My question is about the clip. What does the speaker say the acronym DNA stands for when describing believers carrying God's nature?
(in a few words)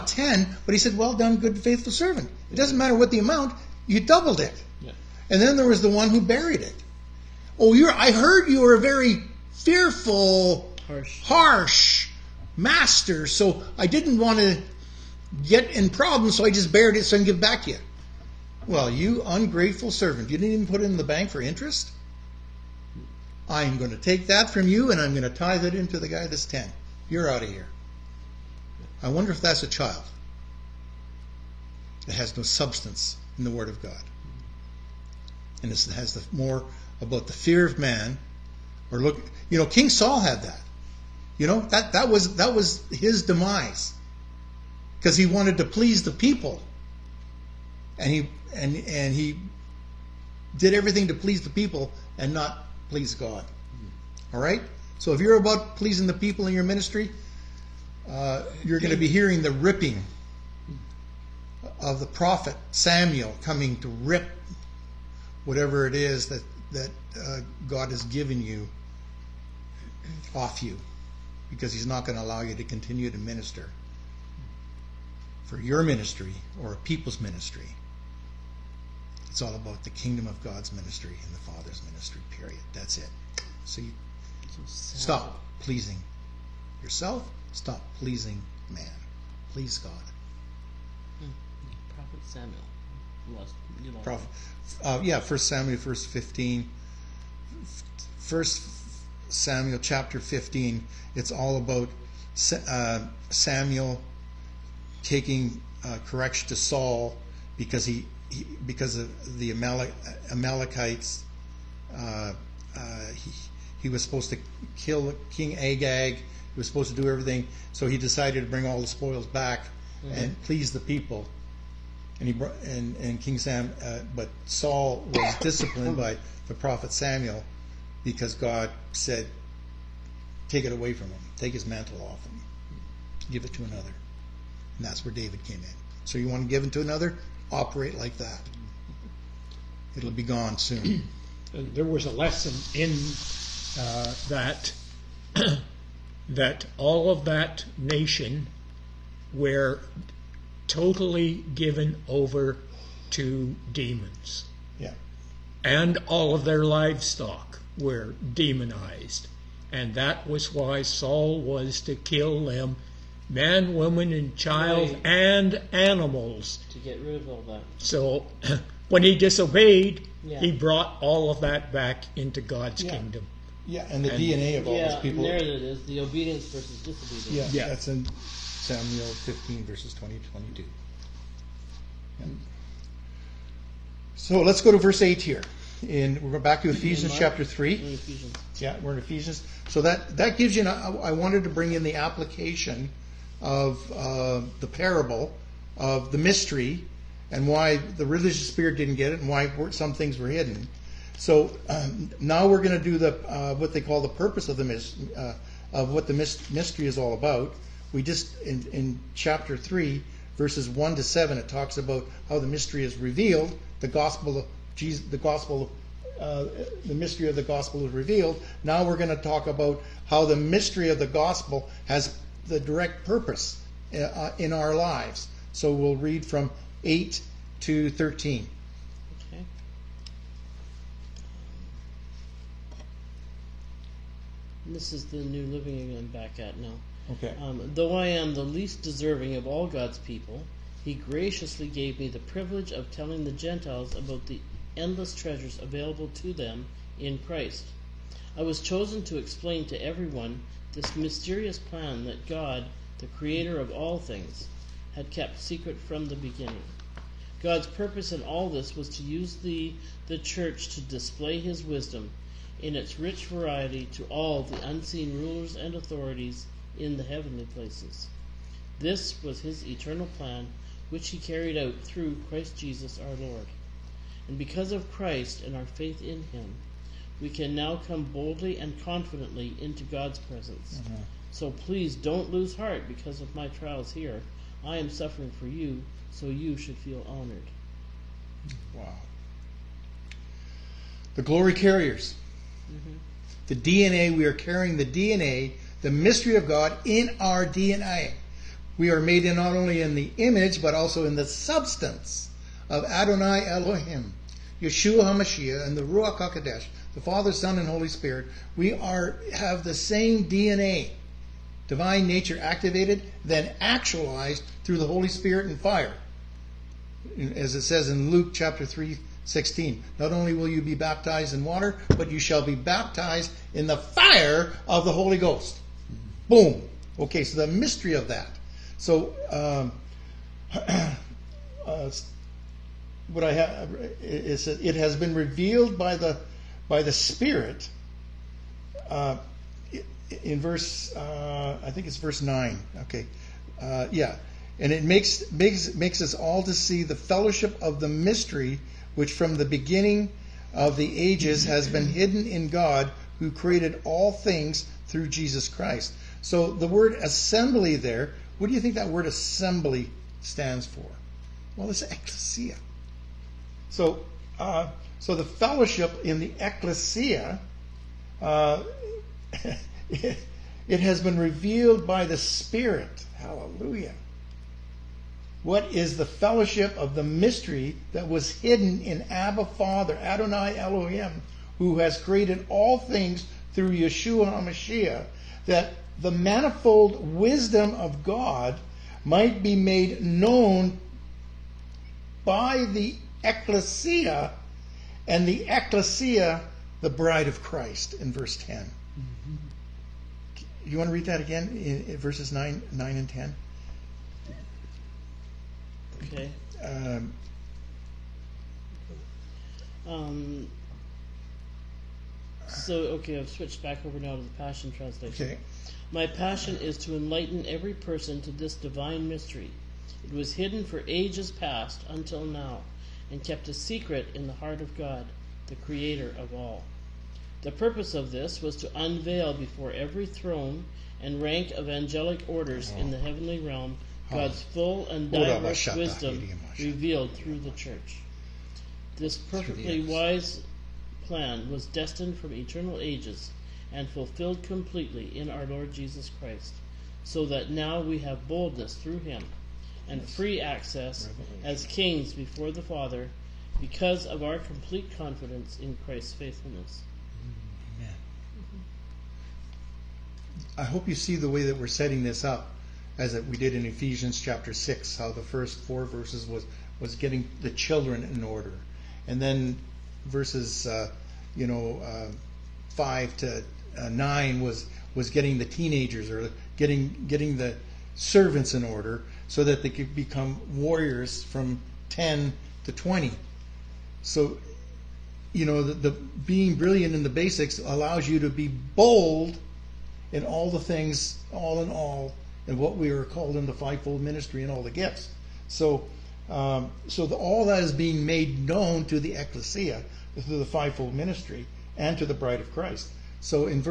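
Divine nature activated.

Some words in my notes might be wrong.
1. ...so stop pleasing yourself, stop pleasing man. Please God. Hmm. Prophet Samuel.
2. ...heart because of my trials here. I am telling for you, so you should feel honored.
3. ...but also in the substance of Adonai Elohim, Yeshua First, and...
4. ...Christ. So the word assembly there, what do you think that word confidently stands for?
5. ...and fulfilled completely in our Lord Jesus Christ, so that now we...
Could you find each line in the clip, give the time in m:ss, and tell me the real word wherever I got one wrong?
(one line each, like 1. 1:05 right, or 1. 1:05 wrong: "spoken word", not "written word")
1. 1:24 right
2. 4:42 wrong: "suffering", not "telling"
3. 5:00 wrong: "HaMashiach", not "First"
4. 5:55 wrong: "assembly", not "confidently"
5. 7:23 right.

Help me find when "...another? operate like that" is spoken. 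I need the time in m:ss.
2:16.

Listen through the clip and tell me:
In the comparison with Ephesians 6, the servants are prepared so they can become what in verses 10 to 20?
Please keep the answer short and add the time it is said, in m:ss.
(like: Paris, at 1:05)
Warriors, at 8:00.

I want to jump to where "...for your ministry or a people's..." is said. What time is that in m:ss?
1:15.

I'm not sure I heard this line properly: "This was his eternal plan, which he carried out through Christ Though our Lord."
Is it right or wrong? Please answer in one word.
wrong.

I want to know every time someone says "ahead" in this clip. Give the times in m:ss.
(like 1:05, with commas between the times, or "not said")
not said.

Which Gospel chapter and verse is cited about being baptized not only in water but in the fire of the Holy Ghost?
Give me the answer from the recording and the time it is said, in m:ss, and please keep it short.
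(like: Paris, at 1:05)
Luke 3:16, at 5:18.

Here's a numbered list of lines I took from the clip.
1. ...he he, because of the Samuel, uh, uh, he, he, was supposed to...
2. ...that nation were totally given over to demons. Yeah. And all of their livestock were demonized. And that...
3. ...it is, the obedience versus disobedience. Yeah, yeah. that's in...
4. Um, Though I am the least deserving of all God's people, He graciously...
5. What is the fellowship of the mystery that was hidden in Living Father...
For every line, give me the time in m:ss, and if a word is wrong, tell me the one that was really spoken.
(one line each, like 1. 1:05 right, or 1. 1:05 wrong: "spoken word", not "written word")
1. 1:47 wrong: "Amalekites", not "Samuel"
2. 2:27 right
3. 2:55 right
4. 3:57 right
5. 6:15 wrong: "Abba", not "Living".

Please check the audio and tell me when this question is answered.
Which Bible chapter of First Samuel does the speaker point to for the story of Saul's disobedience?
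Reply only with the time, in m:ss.
1:39.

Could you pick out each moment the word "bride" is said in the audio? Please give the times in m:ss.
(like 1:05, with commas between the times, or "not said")
6:36, 8:22.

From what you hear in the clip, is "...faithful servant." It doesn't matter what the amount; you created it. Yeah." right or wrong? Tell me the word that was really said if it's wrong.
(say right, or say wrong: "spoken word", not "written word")
wrong: "doubled", not "created".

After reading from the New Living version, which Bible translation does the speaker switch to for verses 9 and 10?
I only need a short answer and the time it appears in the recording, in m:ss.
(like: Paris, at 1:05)
Passion Translation, at 6:54.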